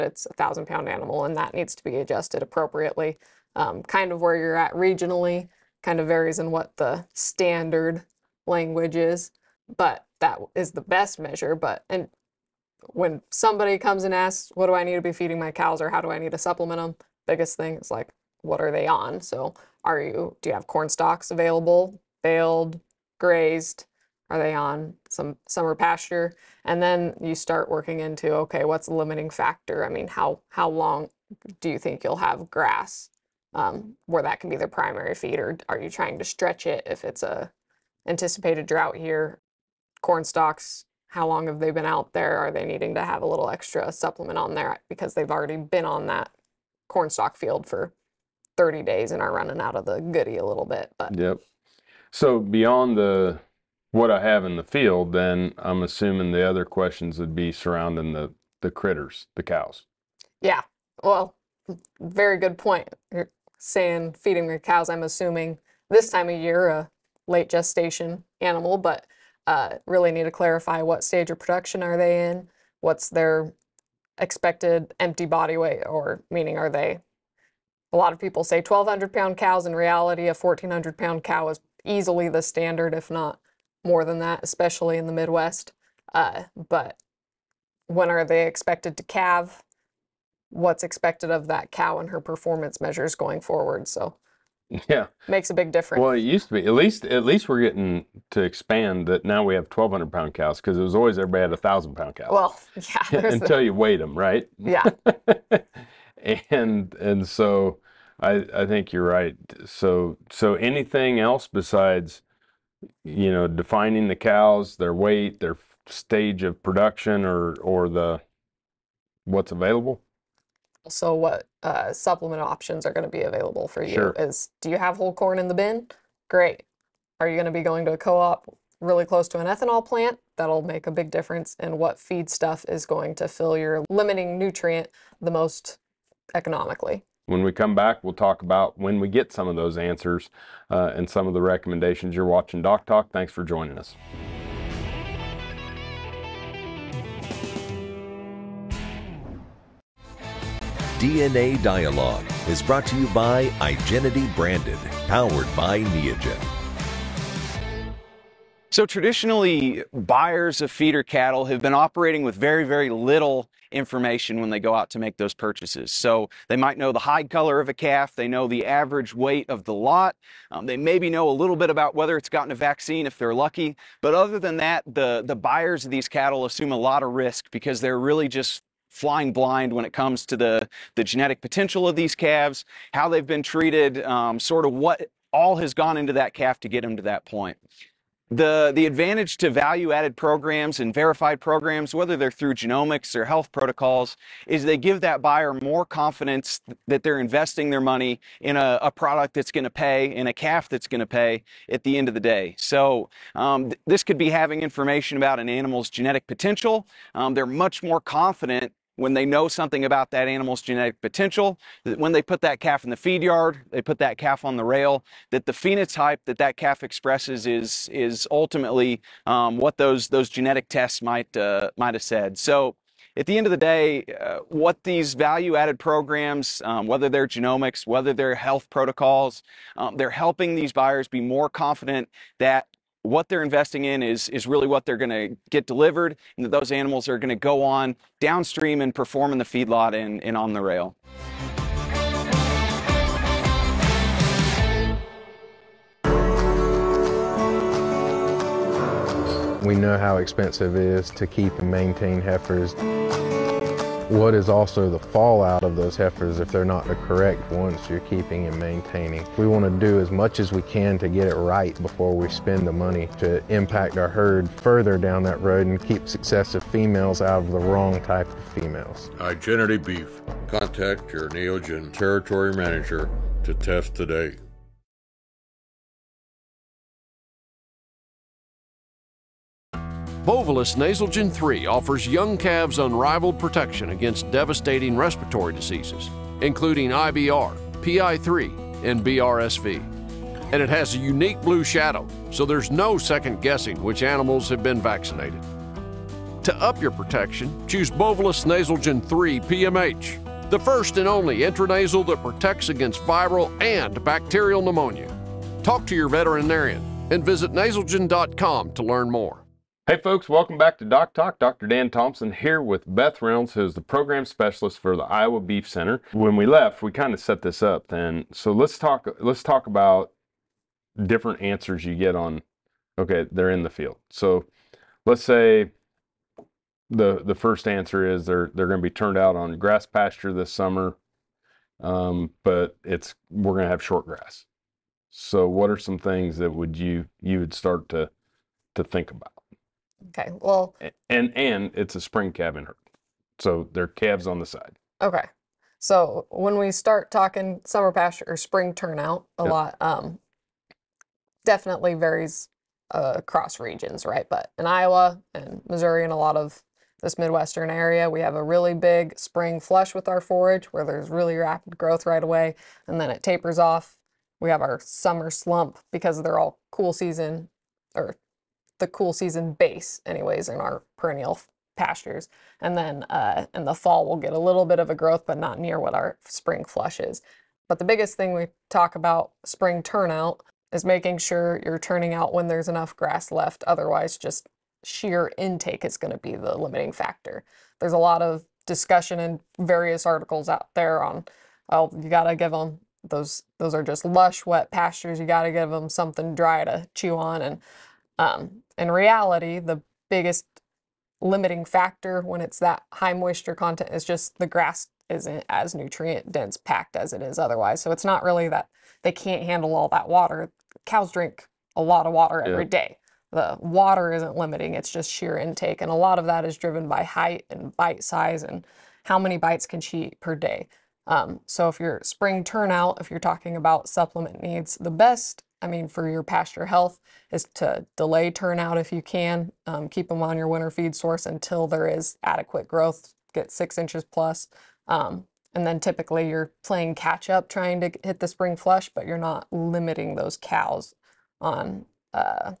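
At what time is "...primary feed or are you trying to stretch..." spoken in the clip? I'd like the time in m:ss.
0:34.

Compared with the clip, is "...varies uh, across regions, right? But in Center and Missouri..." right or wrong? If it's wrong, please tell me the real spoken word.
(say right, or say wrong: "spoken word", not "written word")
wrong: "Iowa", not "Center".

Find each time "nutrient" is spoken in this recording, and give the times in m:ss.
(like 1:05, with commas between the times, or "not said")
2:14, 6:45.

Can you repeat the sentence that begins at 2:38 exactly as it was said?
So, traditionally, buyers of feeder cattle have been operating with very, very little information when they go out to make those purchases.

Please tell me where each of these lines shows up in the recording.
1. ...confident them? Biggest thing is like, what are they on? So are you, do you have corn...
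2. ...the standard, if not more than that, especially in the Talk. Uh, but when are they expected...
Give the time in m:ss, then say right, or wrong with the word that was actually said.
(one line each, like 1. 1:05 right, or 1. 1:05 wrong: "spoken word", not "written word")
1. 0:16 wrong: "supplement", not "confident"
2. 1:22 wrong: "Midwest", not "Talk".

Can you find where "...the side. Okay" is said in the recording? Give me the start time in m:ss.
5:44.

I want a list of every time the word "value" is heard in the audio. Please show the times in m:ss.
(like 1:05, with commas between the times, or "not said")
3:09, 3:45.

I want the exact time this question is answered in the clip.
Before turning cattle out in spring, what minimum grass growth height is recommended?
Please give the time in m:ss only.
7:13.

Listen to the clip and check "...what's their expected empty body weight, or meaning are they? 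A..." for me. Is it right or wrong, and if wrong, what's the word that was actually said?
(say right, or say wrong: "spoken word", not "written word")
right.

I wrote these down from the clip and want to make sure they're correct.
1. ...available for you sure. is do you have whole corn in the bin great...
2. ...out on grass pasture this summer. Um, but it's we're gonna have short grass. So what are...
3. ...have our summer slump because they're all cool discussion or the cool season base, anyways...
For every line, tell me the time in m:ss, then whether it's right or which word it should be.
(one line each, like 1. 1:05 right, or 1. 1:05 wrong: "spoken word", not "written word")
1. 2:03 right
2. 5:29 right
3. 6:04 wrong: "season", not "discussion".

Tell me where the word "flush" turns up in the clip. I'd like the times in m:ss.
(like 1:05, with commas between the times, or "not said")
5:59, 6:16, 7:18.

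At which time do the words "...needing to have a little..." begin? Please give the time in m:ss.
0:42.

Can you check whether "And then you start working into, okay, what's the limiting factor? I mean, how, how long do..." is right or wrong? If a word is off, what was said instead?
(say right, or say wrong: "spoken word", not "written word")
right.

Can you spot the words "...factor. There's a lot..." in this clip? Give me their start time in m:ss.
6:26.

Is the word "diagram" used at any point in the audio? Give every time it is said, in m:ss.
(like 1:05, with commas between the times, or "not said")
not said.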